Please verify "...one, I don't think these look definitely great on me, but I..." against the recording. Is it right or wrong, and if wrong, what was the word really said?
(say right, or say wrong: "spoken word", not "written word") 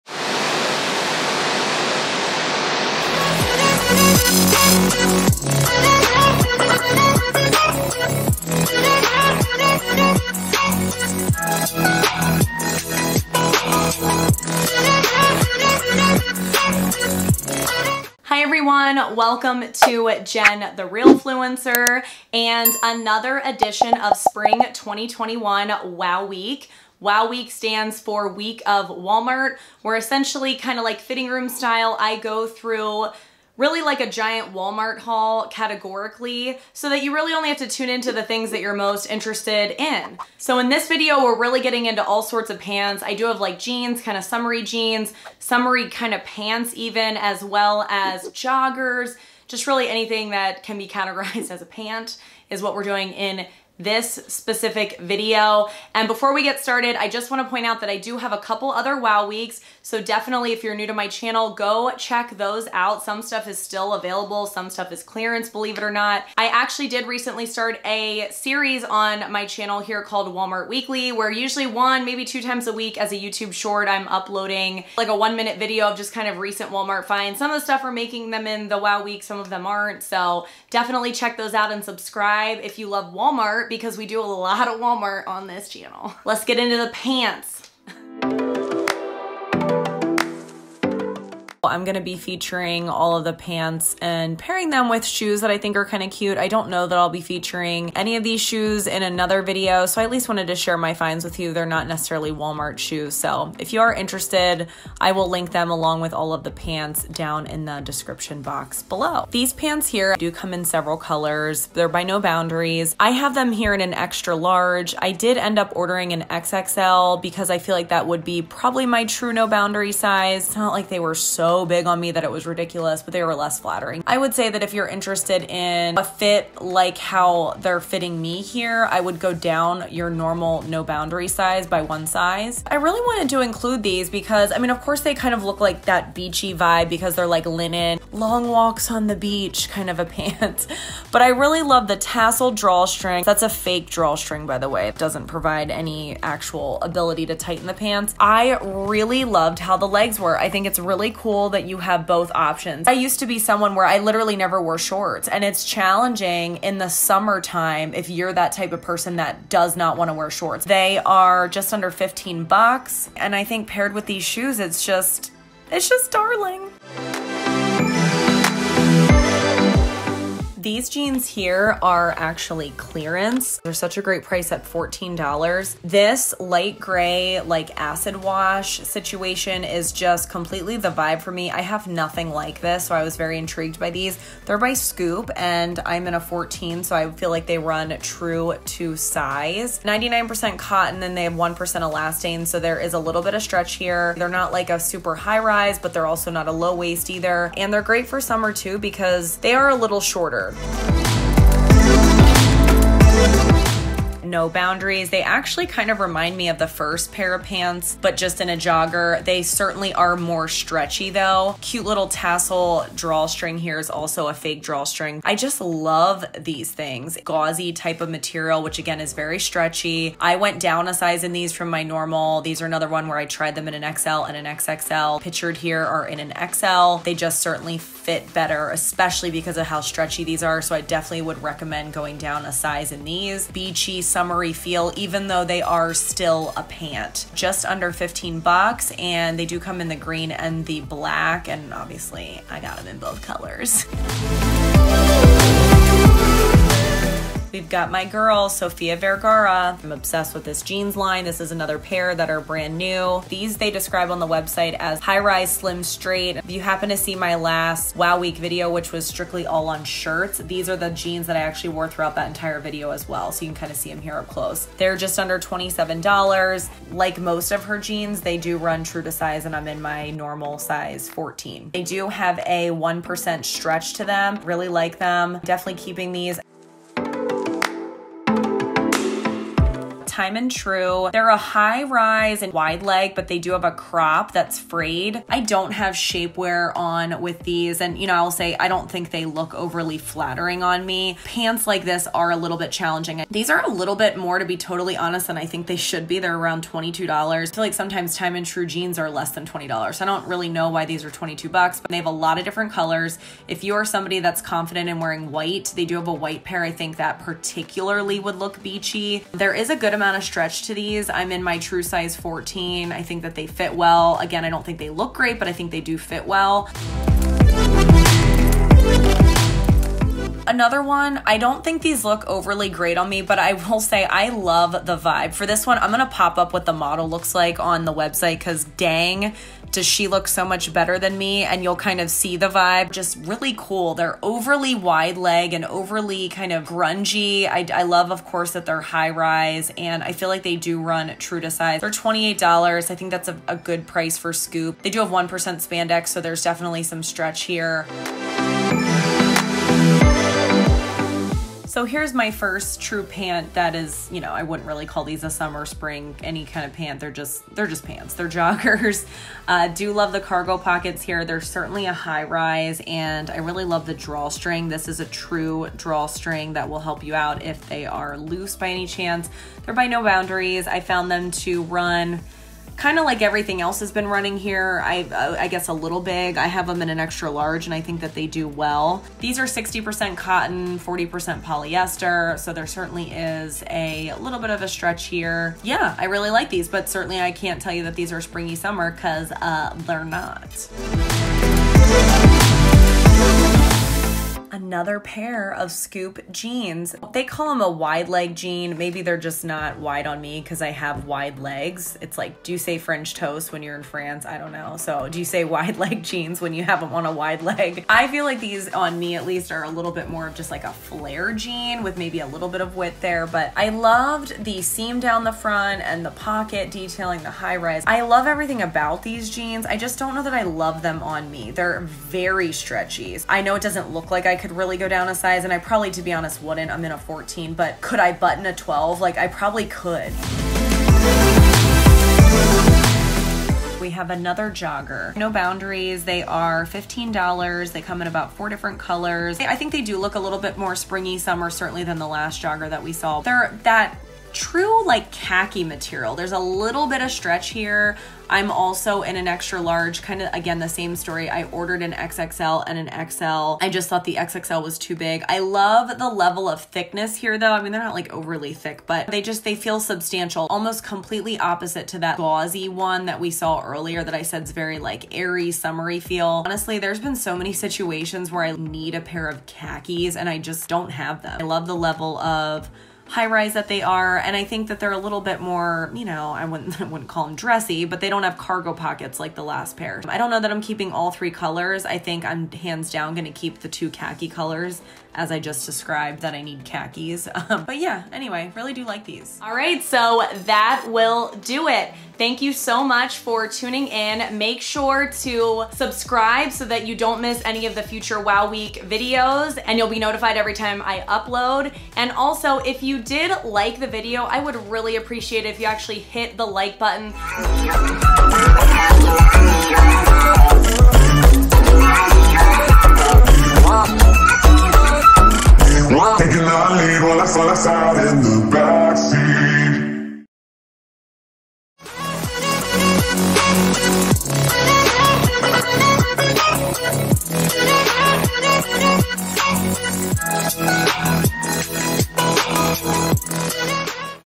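wrong: "overly", not "definitely".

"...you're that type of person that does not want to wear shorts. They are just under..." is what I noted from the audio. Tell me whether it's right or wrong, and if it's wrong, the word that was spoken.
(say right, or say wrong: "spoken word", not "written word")
right.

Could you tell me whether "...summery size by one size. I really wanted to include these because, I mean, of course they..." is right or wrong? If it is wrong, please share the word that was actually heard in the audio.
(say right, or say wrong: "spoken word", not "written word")
wrong: "boundary", not "summery".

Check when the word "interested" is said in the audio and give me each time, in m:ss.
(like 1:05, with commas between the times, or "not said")
0:39, 1:43, 2:04.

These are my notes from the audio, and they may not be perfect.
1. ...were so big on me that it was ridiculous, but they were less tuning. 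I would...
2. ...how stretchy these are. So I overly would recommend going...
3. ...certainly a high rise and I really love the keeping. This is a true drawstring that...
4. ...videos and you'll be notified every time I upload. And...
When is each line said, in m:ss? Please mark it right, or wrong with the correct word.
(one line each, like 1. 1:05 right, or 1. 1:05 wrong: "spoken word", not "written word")
1. 2:00 wrong: "flattering", not "tuning"
2. 3:49 wrong: "definitely", not "overly"
3. 6:01 wrong: "drawstring", not "keeping"
4. 8:18 right.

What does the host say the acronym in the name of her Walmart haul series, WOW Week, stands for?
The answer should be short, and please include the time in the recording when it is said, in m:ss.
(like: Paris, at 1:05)
Week of Walmart, at 0:28.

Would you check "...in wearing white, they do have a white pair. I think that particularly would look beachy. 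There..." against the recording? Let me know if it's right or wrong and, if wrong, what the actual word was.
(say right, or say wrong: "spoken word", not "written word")
right.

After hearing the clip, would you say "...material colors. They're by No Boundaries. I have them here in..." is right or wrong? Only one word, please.
wrong.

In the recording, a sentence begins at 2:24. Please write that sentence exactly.
It doesn't provide any actual ability to tighten the pants.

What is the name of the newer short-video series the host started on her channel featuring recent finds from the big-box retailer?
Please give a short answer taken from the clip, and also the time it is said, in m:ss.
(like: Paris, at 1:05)
Walmart Weekly, at 1:10.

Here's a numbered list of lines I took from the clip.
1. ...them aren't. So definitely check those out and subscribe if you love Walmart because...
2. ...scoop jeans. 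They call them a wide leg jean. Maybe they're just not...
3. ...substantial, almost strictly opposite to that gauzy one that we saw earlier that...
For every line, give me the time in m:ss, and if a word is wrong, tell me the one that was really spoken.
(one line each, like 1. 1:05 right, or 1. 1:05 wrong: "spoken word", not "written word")
1. 1:19 right
2. 6:35 right
3. 7:39 wrong: "completely", not "strictly".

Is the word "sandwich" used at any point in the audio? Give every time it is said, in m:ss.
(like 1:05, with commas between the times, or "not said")
not said.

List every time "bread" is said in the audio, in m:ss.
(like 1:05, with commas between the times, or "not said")
not said.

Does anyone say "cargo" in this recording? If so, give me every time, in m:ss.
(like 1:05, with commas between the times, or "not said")
6:00, 7:58.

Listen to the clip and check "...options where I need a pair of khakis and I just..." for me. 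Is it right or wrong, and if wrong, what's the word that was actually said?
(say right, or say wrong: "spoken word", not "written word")
wrong: "situations", not "options".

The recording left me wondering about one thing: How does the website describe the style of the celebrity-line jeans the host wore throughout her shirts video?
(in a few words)
high-rise slim straight.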